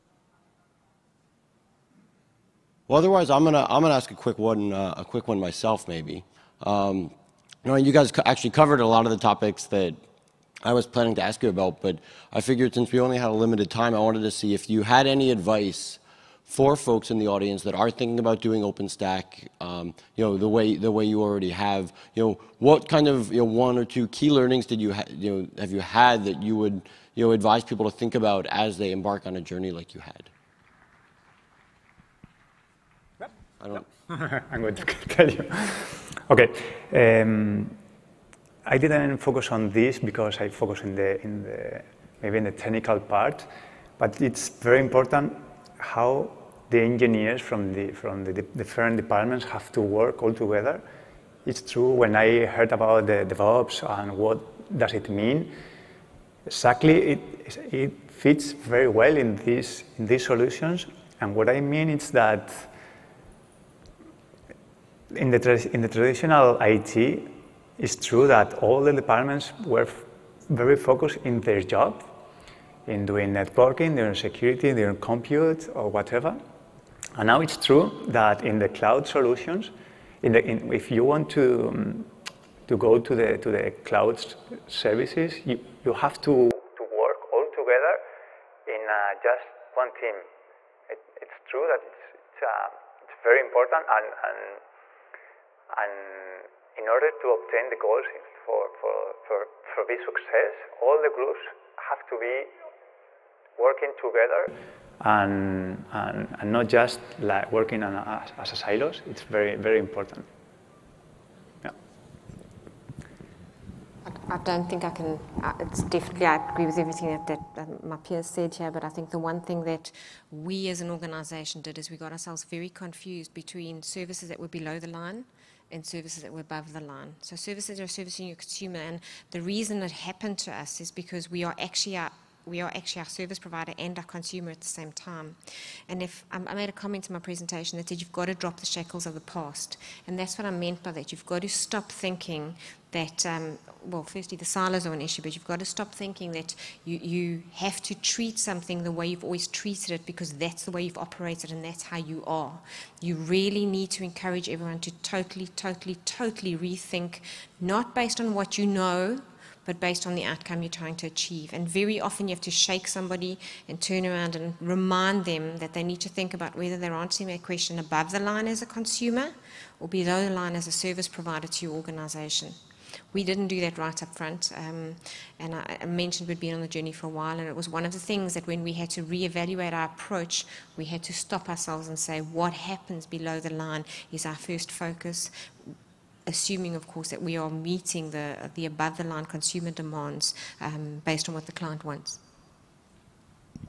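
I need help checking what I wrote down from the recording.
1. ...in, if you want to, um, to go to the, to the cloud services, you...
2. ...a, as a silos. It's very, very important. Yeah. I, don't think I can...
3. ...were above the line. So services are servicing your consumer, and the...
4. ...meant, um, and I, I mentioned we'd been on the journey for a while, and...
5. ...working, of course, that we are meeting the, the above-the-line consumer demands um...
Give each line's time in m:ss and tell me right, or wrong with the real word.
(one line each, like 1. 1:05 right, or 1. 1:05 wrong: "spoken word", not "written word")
1. 1:20 right
2. 1:47 right
3. 2:06 right
4. 2:54 wrong: "front", not "meant"
5. 3:06 wrong: "assuming", not "working".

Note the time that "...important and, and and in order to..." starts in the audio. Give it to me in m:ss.
1:33.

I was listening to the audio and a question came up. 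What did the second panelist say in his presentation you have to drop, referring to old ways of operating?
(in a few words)
the shackles of the past.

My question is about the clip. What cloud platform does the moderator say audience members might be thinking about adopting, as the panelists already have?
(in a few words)
OpenStack.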